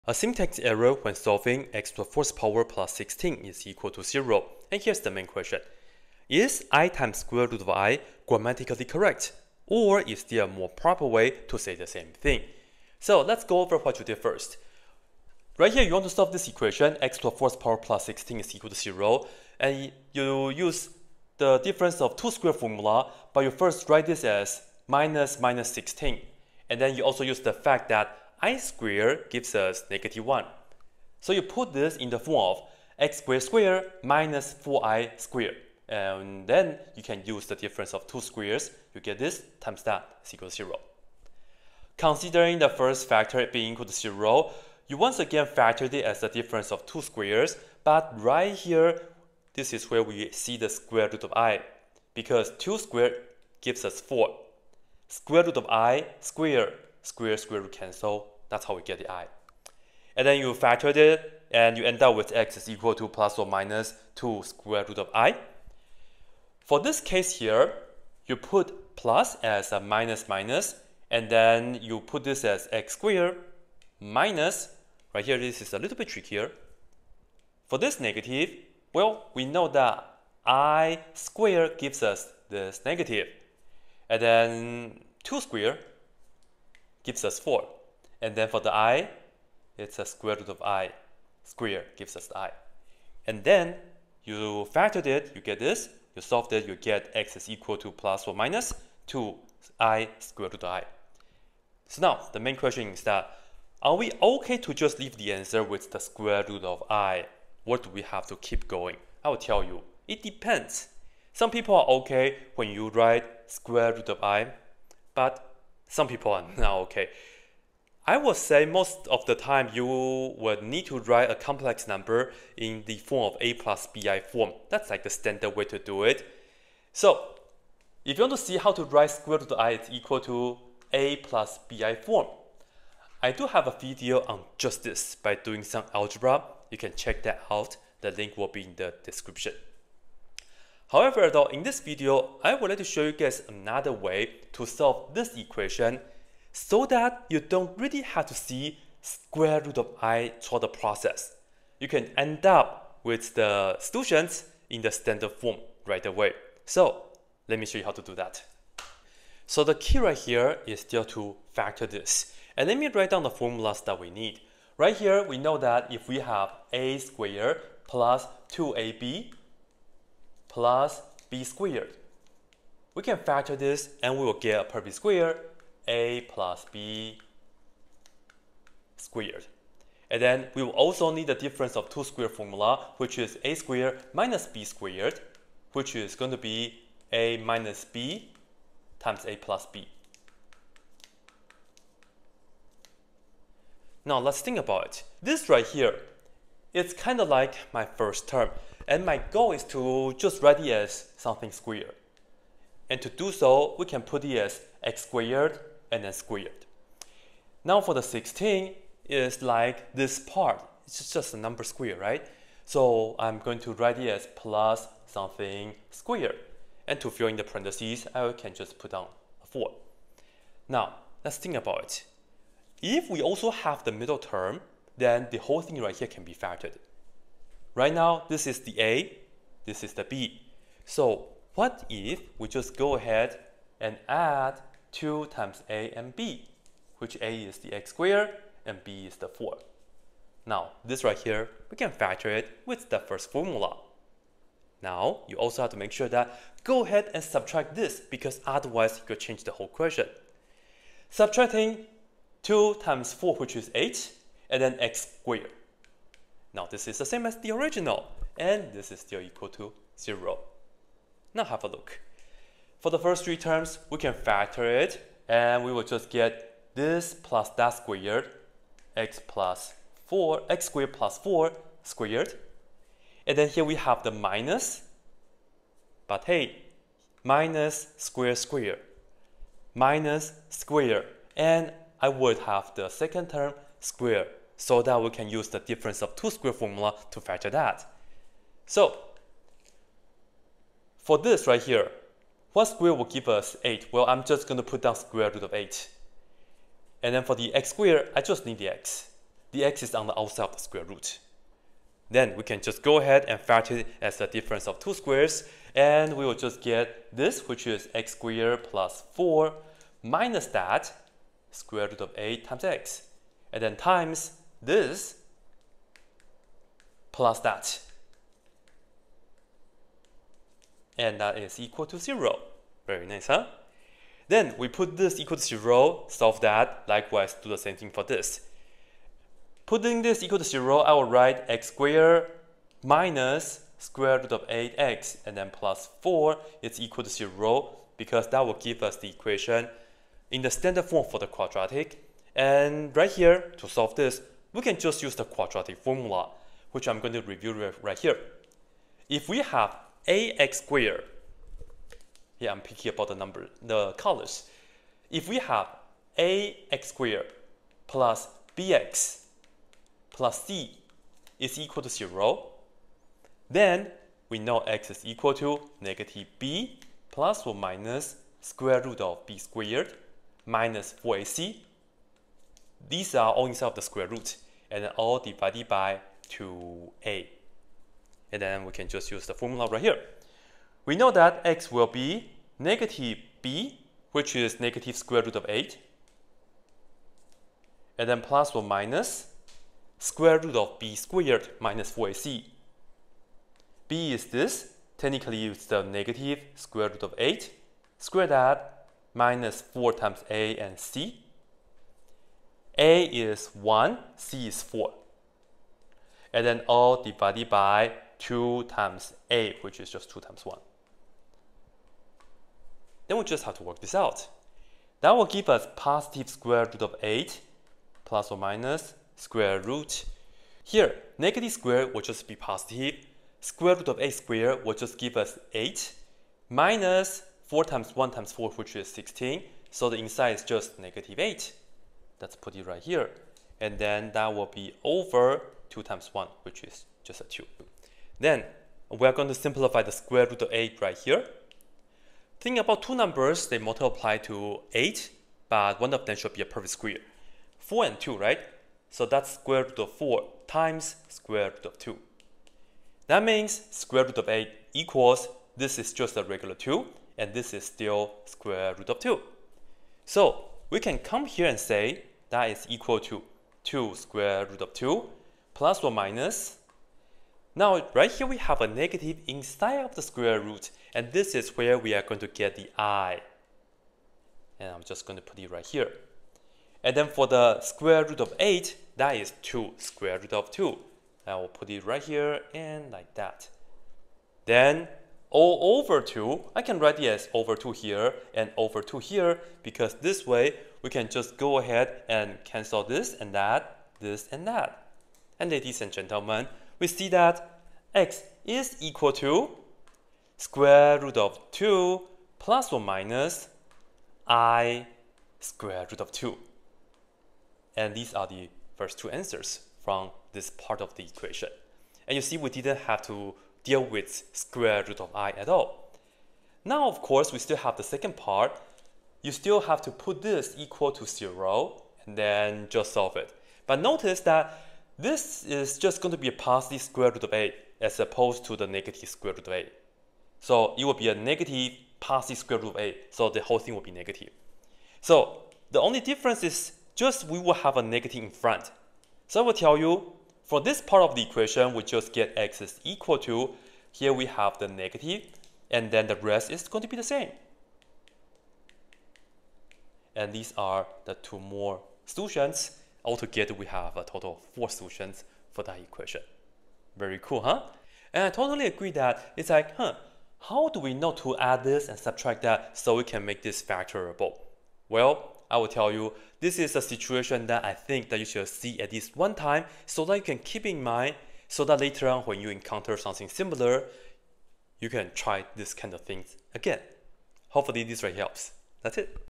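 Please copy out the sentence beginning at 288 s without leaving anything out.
So, for this right here, what square will give us 8?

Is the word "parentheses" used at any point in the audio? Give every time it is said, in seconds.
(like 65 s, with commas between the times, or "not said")
217 s.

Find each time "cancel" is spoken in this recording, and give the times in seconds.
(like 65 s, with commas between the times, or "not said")
57 s, 492 s.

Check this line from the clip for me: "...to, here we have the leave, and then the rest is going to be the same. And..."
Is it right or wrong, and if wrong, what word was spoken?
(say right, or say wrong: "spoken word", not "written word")
wrong: "negative", not "leave".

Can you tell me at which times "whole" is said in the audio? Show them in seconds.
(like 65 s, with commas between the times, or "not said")
225 s, 249 s, 533 s.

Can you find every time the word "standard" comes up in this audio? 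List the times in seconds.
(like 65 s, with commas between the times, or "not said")
125 s, 154 s, 340 s.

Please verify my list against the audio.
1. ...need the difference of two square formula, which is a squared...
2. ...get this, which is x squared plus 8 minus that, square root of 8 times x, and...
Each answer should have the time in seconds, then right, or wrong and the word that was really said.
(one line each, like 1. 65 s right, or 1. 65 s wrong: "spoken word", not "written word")
1. 181 s right
2. 306 s wrong: "4", not "8".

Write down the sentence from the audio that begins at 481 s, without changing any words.
I will put it right here and like that.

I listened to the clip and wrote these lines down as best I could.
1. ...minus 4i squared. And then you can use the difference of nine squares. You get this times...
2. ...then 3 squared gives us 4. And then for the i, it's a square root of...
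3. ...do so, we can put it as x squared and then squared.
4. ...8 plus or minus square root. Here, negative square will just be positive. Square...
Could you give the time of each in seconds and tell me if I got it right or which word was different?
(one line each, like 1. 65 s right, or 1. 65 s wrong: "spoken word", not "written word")
1. 34 s wrong: "two", not "nine"
2. 84 s wrong: "2", not "3"
3. 203 s right
4. 417 s right.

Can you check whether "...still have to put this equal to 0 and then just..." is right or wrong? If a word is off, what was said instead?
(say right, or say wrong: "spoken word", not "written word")
right.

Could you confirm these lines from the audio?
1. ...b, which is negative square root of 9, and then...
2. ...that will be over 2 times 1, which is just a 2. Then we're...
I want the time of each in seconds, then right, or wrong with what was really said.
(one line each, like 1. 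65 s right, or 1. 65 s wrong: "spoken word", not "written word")
1. 383 s wrong: "8", not "9"
2. 434 s right.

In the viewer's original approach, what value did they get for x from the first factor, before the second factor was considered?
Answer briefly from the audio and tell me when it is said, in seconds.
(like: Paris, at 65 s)
plus or minus 2 square root of i, at 62 s.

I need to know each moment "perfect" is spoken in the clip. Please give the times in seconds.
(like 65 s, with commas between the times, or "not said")
174 s, 446 s.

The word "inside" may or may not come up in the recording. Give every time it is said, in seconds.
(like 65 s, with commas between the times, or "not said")
373 s, 429 s, 469 s.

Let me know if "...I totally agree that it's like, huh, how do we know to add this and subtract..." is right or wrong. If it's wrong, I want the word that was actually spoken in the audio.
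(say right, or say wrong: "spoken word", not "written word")
right.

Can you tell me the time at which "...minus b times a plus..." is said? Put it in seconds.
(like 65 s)
187 s.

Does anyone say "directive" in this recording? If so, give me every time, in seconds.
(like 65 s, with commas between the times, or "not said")
not said.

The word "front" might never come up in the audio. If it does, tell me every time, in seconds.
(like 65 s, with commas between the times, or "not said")
538 s.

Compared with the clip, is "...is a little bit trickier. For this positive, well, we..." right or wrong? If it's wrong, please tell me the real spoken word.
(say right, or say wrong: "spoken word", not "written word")
wrong: "negative", not "positive".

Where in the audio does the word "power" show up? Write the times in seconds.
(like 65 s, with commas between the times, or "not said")
2 s, 17 s.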